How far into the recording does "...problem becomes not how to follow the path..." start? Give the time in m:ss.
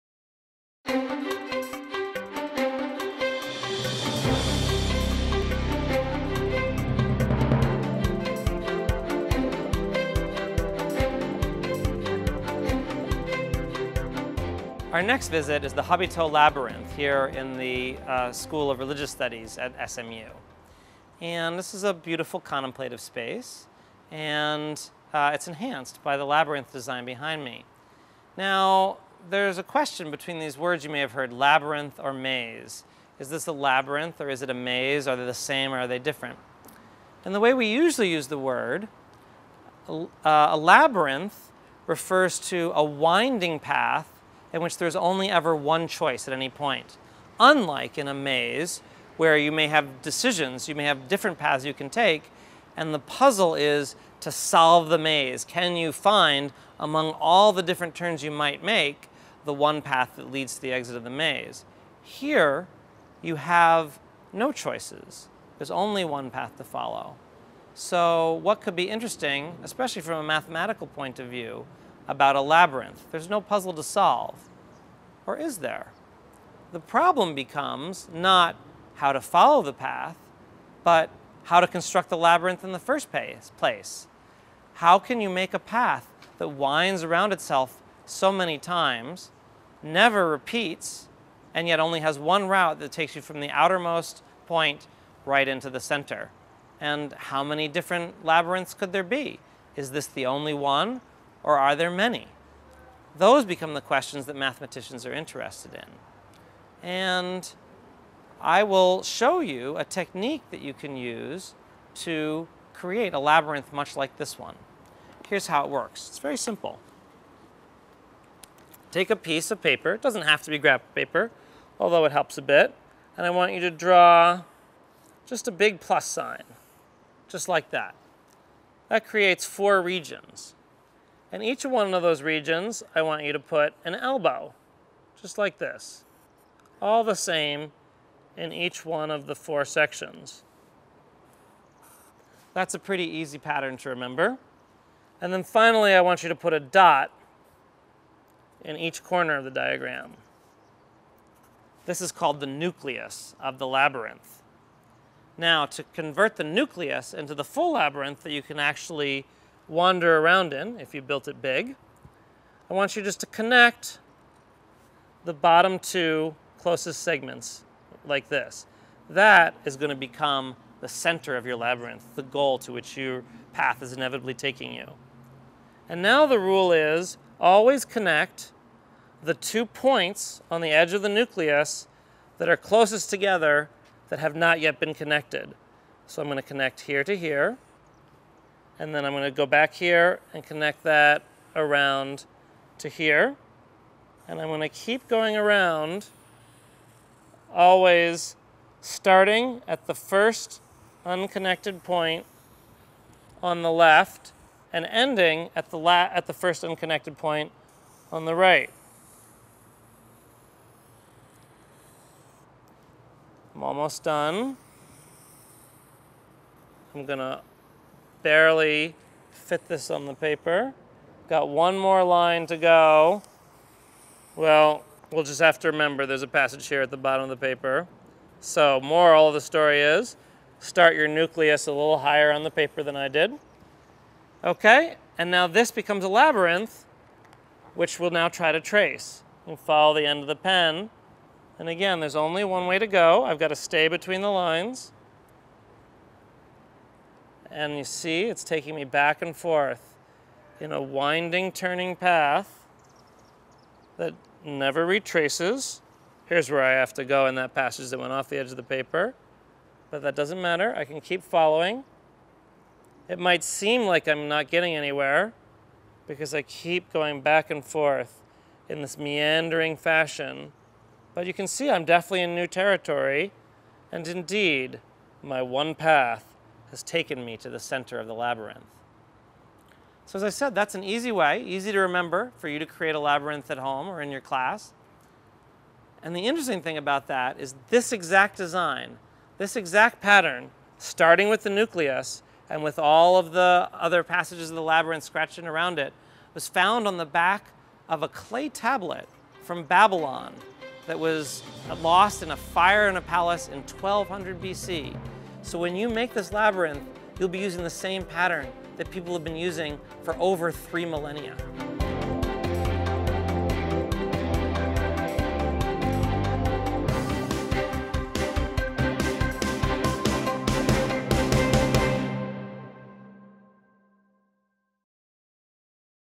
1:16.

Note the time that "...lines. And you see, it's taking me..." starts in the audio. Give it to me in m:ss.
4:04.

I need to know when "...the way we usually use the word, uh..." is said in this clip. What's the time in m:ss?
0:37.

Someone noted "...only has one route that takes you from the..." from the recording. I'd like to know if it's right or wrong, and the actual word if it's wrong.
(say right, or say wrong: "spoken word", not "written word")
right.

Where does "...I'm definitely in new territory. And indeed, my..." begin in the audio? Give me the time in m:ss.
4:31.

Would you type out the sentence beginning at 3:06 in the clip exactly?
So I'm going to connect here to here, and then I'm gonna go back here and connect that around to here.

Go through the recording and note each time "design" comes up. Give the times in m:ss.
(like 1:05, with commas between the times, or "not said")
0:26, 4:48.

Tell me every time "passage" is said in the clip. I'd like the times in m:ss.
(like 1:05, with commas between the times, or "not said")
3:46, 4:17, 4:54.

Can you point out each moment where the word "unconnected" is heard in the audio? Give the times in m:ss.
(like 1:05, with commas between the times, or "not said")
3:21, 3:26.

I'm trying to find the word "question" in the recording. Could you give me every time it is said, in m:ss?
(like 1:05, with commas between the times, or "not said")
0:29, 1:43.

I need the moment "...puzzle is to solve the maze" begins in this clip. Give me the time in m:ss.
0:52.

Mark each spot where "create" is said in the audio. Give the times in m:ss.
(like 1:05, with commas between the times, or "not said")
1:52, 2:09, 4:42.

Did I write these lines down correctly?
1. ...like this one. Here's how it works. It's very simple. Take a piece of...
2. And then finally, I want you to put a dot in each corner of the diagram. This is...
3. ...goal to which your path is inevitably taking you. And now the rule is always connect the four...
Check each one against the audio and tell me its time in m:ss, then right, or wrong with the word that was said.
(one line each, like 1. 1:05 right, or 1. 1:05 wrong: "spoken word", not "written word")
1. 1:53 right
2. 2:25 right
3. 2:52 wrong: "two", not "four".